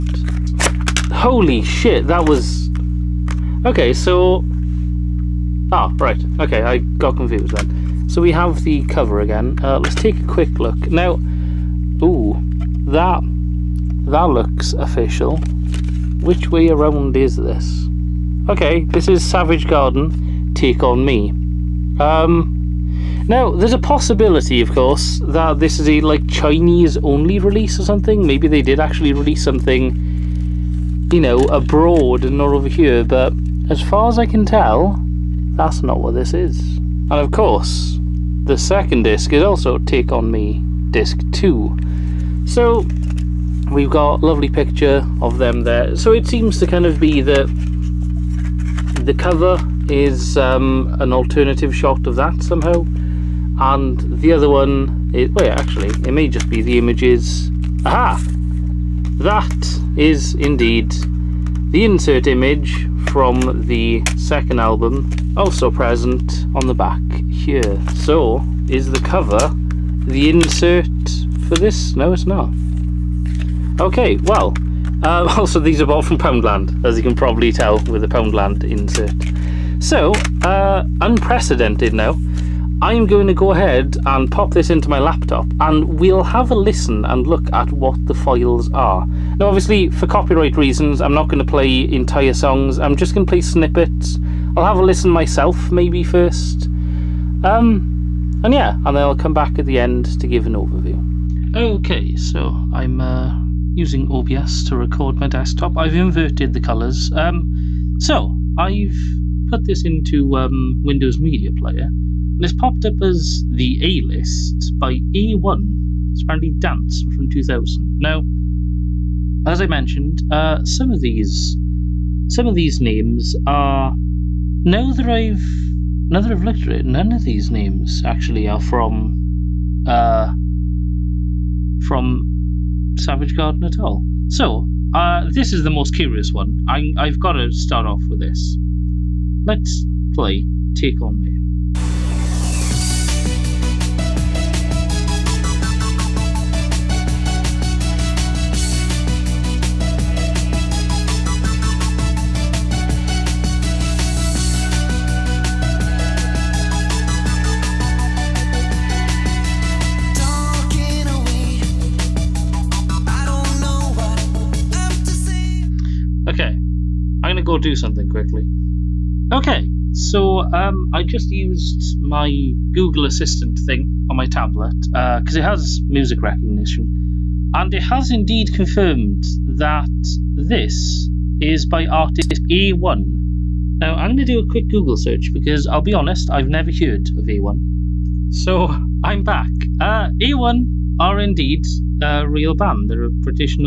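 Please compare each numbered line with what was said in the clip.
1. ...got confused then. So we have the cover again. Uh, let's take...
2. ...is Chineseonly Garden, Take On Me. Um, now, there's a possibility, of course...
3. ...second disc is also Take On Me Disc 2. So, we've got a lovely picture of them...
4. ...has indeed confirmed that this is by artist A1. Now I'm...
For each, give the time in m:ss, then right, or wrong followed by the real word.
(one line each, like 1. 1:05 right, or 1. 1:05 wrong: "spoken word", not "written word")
1. 0:06 right
2. 0:19 wrong: "Savage", not "Chineseonly"
3. 0:38 right
4. 2:57 right.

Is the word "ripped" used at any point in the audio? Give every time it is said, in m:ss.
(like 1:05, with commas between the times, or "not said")
not said.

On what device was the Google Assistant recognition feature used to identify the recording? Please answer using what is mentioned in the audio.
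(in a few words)
tablet.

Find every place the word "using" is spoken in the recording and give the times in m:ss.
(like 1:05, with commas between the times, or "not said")
1:43.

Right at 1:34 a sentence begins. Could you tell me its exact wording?
I'll have a listen myself maybe first.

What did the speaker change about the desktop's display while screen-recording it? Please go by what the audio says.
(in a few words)
inverted the colours.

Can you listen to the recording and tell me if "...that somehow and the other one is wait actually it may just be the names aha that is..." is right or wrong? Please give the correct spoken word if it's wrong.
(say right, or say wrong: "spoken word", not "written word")
wrong: "images", not "names".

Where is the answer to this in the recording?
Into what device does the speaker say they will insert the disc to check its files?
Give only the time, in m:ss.
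1:24.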